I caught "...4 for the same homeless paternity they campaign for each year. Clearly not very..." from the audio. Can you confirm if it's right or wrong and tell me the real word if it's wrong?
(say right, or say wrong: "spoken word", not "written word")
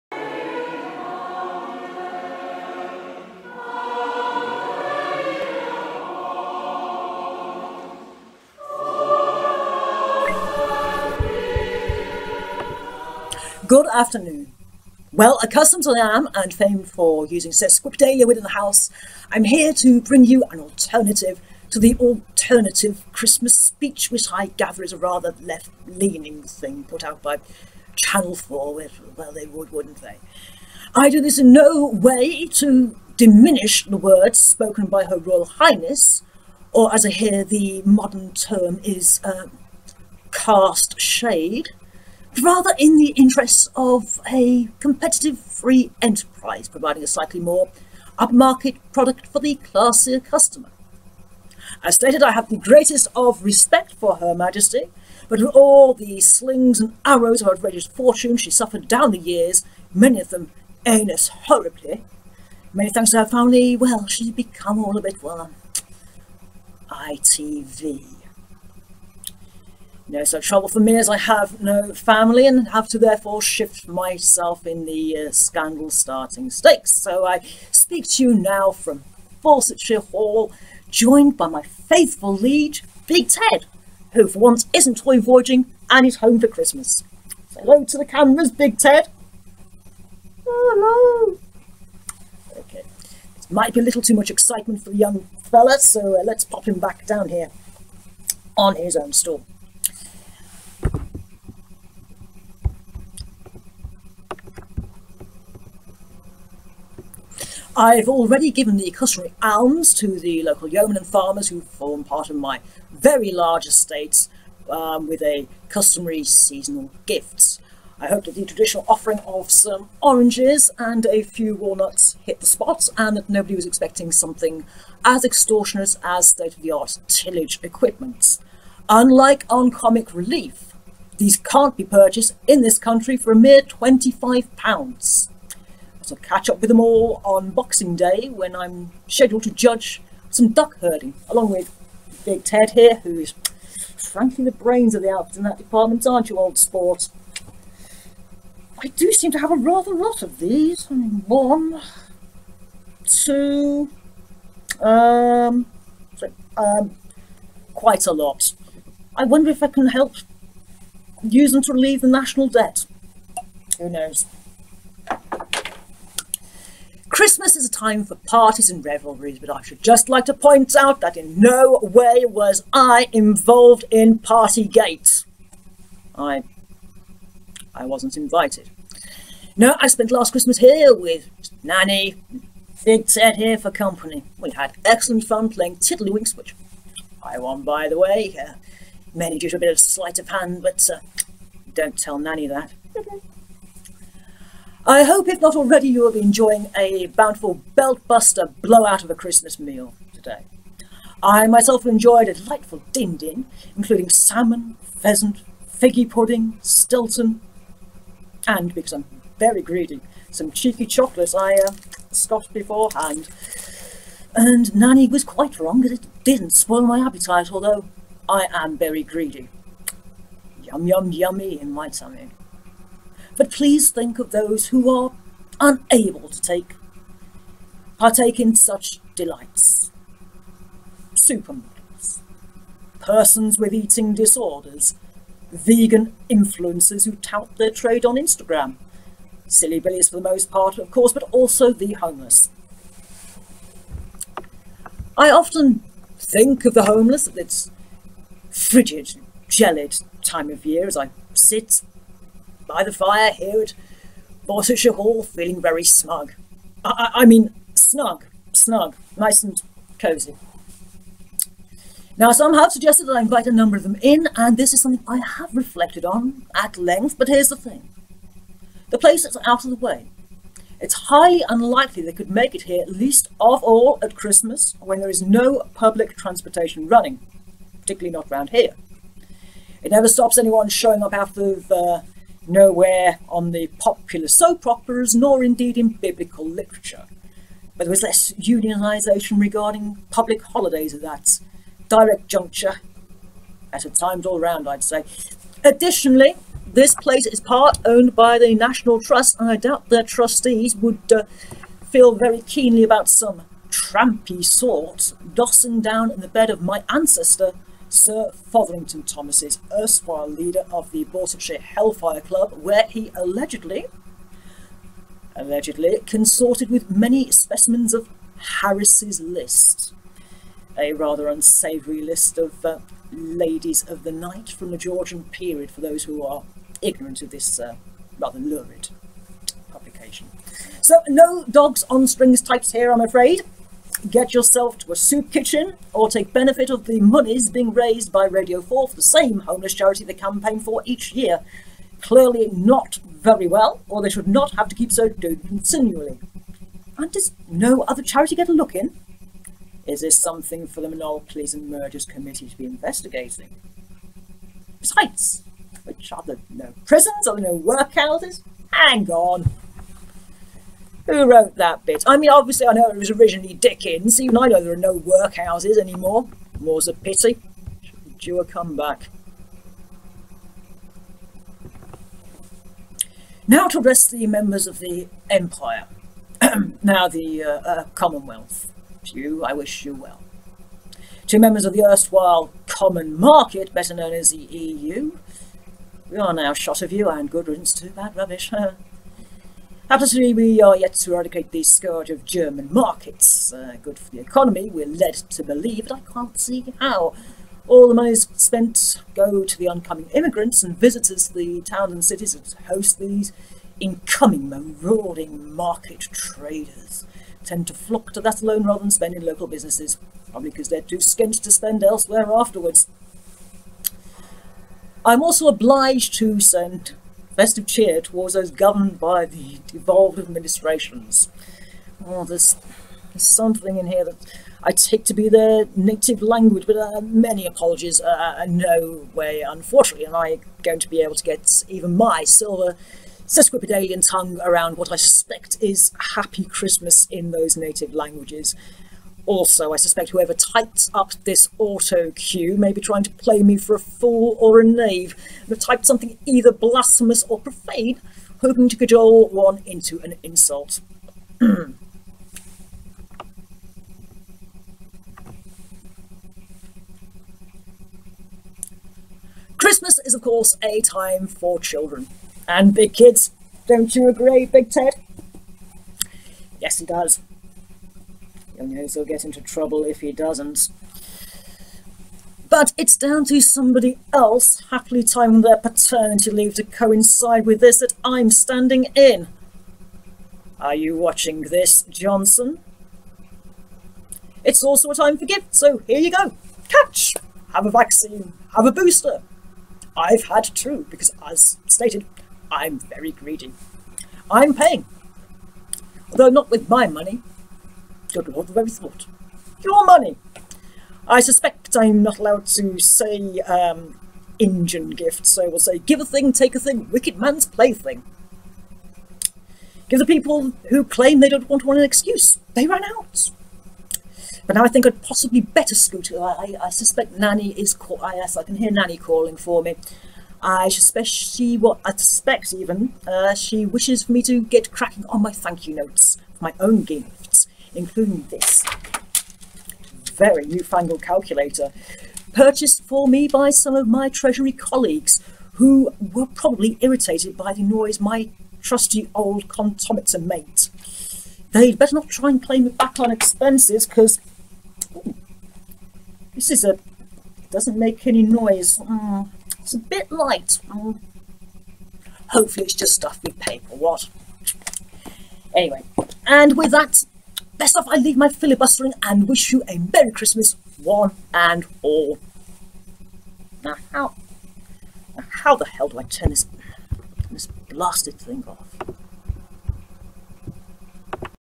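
wrong: "charity", not "paternity".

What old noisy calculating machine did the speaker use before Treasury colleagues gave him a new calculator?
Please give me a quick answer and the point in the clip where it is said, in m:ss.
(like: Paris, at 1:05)
Comptometer, at 8:59.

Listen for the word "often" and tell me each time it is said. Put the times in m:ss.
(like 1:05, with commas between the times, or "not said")
4:05.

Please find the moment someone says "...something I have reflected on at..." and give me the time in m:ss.
4:24.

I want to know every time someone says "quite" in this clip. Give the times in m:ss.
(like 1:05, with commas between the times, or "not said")
2:37, 3:35.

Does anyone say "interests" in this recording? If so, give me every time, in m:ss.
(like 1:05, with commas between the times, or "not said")
0:43.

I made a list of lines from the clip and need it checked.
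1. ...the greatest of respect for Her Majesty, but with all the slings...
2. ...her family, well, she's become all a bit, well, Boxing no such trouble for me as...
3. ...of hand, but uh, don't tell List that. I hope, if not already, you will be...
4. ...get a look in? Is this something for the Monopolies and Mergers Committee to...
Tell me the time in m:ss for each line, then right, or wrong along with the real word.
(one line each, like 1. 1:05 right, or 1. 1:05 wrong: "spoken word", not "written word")
1. 0:52 right
2. 1:03 wrong: "ITV", not "Boxing"
3. 3:10 wrong: "Nanny", not "List"
4. 5:48 right.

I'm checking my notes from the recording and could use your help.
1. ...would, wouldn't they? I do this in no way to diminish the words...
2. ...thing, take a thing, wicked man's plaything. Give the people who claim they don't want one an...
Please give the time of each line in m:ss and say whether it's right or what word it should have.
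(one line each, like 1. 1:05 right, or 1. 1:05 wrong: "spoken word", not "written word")
1. 0:29 right
2. 8:26 right.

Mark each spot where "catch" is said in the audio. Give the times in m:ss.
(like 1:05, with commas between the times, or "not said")
2:16, 8:06.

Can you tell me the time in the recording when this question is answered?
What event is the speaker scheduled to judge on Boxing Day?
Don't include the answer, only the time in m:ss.
2:20.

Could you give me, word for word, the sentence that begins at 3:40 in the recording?
Yum yum yummy in my tummy.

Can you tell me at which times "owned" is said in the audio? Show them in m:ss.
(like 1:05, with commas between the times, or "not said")
4:57.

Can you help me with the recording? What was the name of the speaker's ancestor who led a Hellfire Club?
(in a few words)
Sir Fotherington Thomas.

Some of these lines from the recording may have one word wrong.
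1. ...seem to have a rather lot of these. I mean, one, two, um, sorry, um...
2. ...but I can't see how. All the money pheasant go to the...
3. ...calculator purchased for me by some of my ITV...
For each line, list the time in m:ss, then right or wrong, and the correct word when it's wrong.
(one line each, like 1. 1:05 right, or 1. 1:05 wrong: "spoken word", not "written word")
1. 2:29 right
2. 6:35 wrong: "spent", not "pheasant"
3. 8:51 wrong: "Treasury", not "ITV".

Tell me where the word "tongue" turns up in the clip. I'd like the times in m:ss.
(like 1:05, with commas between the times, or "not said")
7:14.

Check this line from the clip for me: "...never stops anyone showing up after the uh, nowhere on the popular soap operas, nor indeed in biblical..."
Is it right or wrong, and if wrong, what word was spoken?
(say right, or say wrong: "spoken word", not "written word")
right.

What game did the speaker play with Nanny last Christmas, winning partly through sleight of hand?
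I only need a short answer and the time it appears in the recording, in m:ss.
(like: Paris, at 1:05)
Tiddlywinks, at 3:05.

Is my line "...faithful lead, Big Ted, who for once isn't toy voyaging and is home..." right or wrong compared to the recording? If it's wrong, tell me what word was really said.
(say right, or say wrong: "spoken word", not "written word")
right.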